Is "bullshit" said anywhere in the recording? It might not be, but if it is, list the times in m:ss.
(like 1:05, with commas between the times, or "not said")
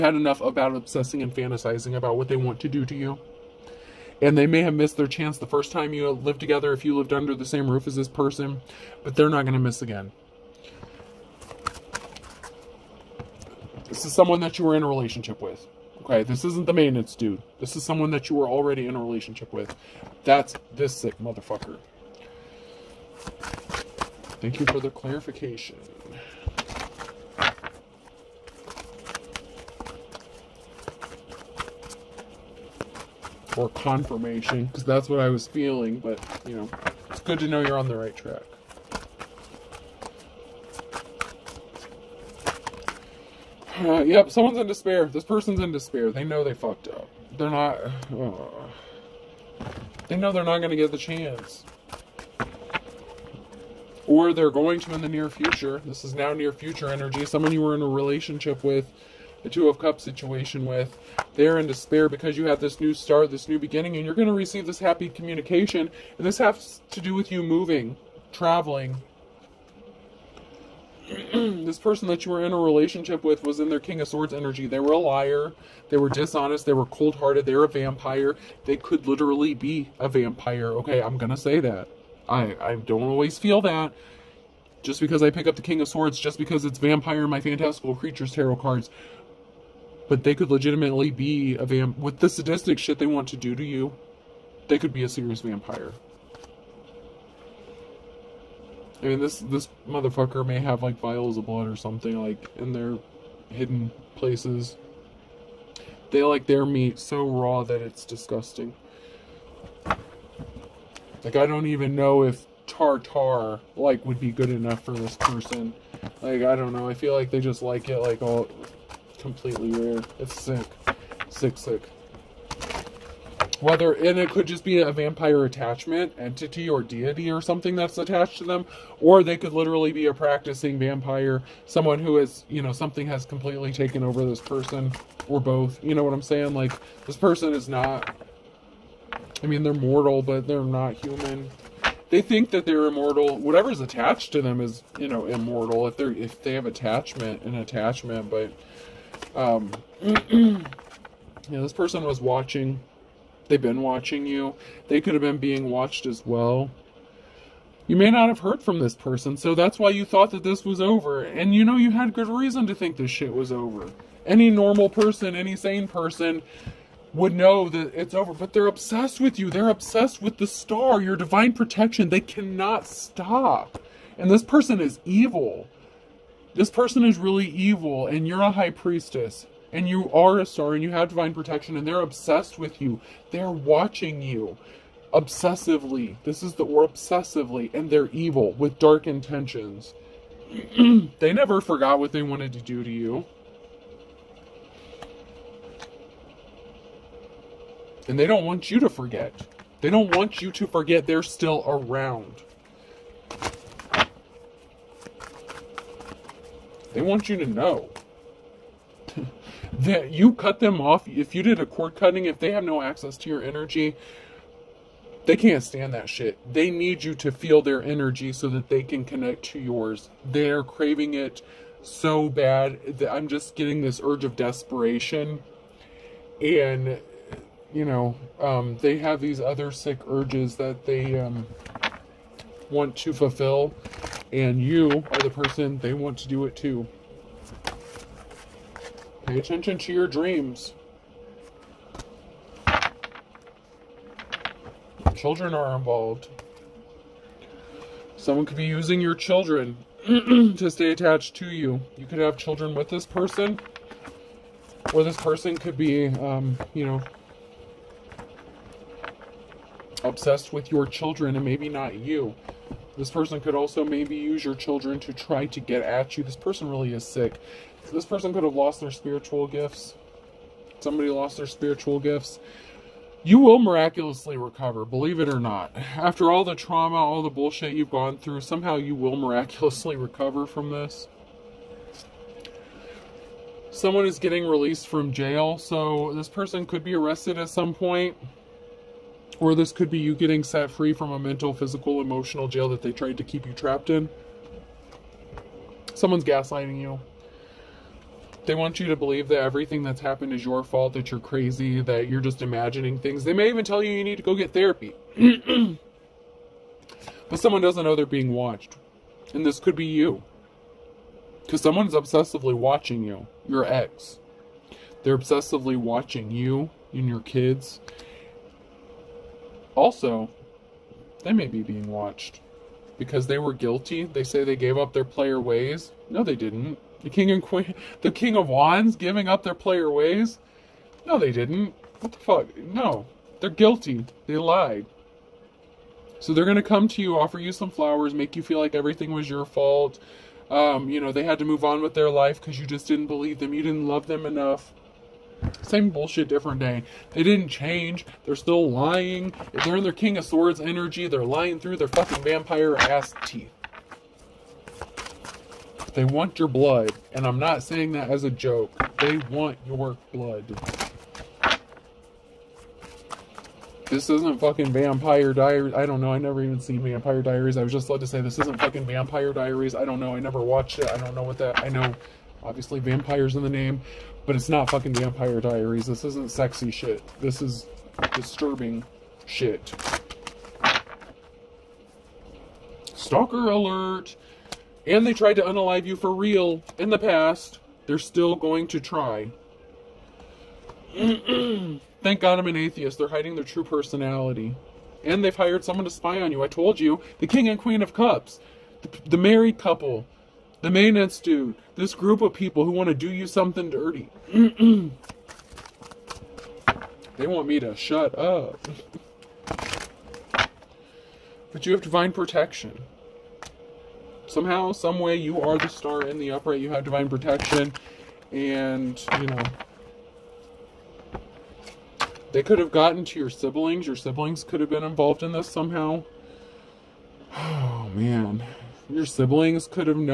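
4:37, 5:45.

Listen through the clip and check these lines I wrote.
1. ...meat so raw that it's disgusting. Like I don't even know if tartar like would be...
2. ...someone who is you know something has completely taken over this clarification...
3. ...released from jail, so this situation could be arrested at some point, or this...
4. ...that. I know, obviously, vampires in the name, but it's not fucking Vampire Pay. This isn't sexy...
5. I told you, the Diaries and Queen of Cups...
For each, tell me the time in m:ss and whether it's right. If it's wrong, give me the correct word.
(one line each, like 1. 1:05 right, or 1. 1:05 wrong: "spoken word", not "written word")
1. 1:46 right
2. 2:11 wrong: "person", not "clarification"
3. 4:44 wrong: "person", not "situation"
4. 6:11 wrong: "Diaries", not "Pay"
5. 6:36 wrong: "King", not "Diaries".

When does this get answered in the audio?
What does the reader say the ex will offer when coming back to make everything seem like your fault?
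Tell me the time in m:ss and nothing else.
5:37.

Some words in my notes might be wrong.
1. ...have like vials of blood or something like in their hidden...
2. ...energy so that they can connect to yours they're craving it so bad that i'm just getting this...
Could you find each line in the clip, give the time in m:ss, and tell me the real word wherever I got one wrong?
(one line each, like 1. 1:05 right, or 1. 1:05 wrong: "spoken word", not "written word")
1. 1:40 right
2. 3:37 right.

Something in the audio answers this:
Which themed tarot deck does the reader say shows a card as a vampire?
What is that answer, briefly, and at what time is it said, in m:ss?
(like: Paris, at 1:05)
Fantastical Creatures, at 1:27.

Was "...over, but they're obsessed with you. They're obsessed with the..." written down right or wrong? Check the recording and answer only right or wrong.
right.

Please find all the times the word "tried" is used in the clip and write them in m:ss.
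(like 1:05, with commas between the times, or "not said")
4:52, 6:25.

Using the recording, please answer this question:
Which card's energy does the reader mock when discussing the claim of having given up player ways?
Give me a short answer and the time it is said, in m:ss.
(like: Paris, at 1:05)
King of Wands, at 5:28.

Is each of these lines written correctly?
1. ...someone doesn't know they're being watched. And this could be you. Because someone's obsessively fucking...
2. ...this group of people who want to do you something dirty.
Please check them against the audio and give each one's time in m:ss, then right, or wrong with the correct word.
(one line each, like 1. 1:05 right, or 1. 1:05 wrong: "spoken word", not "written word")
1. 5:07 wrong: "watching", not "fucking"
2. 6:41 right.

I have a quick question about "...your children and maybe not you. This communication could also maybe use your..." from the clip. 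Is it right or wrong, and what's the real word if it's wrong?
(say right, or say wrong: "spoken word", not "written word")
wrong: "person", not "communication".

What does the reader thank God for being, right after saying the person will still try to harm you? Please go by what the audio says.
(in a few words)
An atheist.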